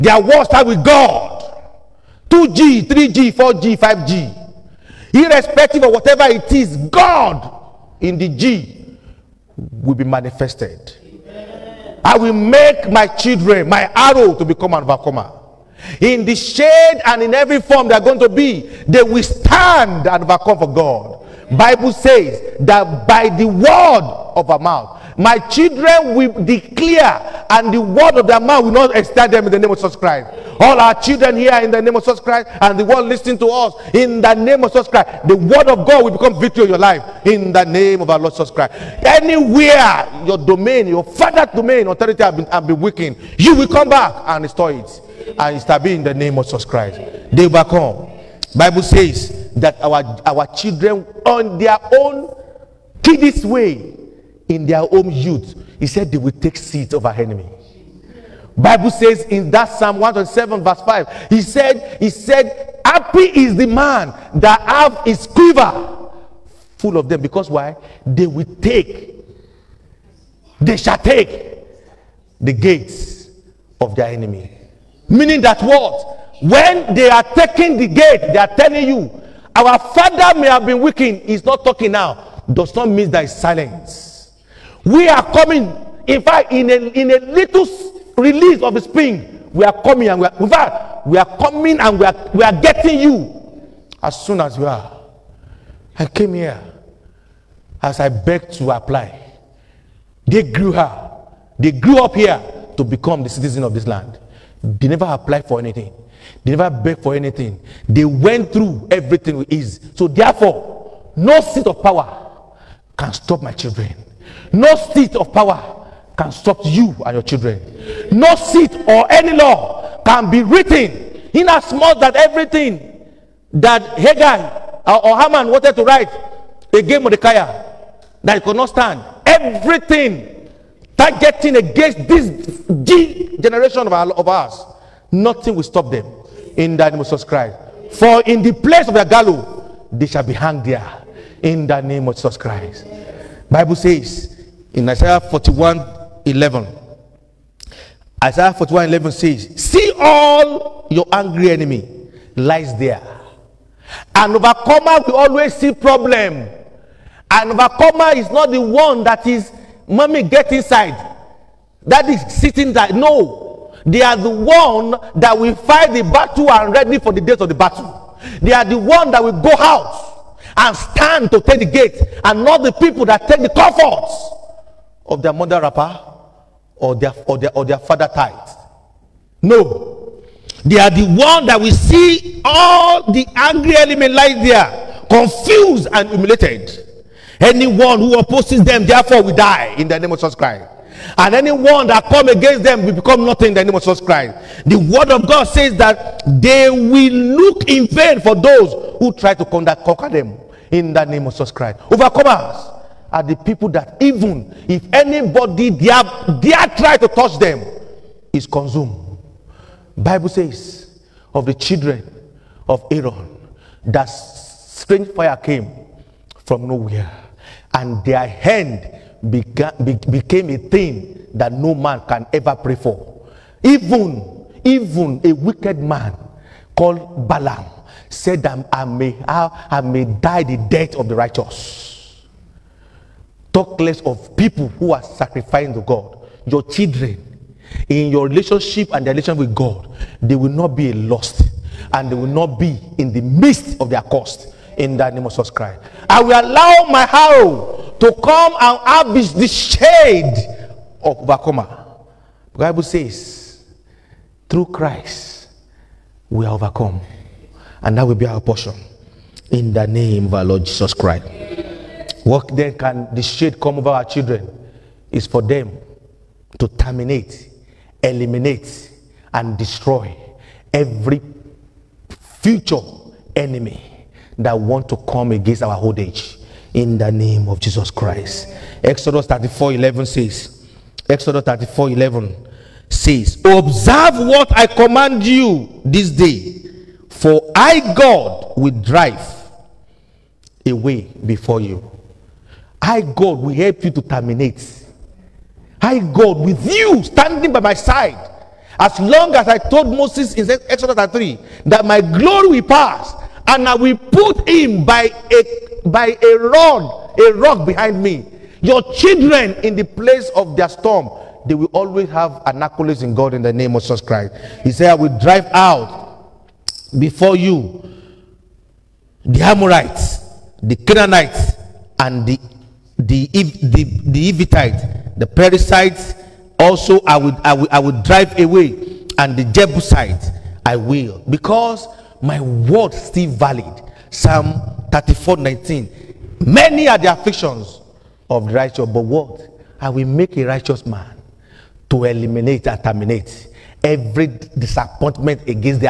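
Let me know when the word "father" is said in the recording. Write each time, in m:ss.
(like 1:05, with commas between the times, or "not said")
0:41, 1:19, 2:57.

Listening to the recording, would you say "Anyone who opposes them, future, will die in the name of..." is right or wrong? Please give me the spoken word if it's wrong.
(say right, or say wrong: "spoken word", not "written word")
wrong: "therefore", not "future".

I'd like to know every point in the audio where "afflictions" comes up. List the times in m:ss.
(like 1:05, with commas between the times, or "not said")
5:37.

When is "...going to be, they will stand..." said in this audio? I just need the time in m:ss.
0:17.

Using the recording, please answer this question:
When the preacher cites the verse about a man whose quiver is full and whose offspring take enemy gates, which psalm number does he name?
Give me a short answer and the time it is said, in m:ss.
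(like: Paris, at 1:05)
107, at 0:59.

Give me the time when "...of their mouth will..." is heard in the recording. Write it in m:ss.
0:28.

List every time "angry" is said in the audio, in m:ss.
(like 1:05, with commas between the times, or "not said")
2:31, 3:03.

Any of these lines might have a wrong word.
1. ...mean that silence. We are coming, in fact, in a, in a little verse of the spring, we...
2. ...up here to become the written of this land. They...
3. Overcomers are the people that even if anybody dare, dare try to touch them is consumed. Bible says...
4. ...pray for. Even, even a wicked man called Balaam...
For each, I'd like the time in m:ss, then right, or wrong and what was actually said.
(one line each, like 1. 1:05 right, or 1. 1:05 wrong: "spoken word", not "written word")
1. 1:22 wrong: "release", not "verse"
2. 1:42 wrong: "citizen", not "written"
3. 3:21 right
4. 3:42 right.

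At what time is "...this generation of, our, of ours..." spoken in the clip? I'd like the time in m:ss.
2:12.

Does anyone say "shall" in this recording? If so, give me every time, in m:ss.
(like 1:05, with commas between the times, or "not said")
1:10, 2:20.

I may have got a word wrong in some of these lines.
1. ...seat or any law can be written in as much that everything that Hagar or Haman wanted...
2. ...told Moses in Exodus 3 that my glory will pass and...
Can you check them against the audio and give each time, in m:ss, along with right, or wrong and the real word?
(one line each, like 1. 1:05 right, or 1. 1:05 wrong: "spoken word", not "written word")
1. 1:58 right
2. 4:59 right.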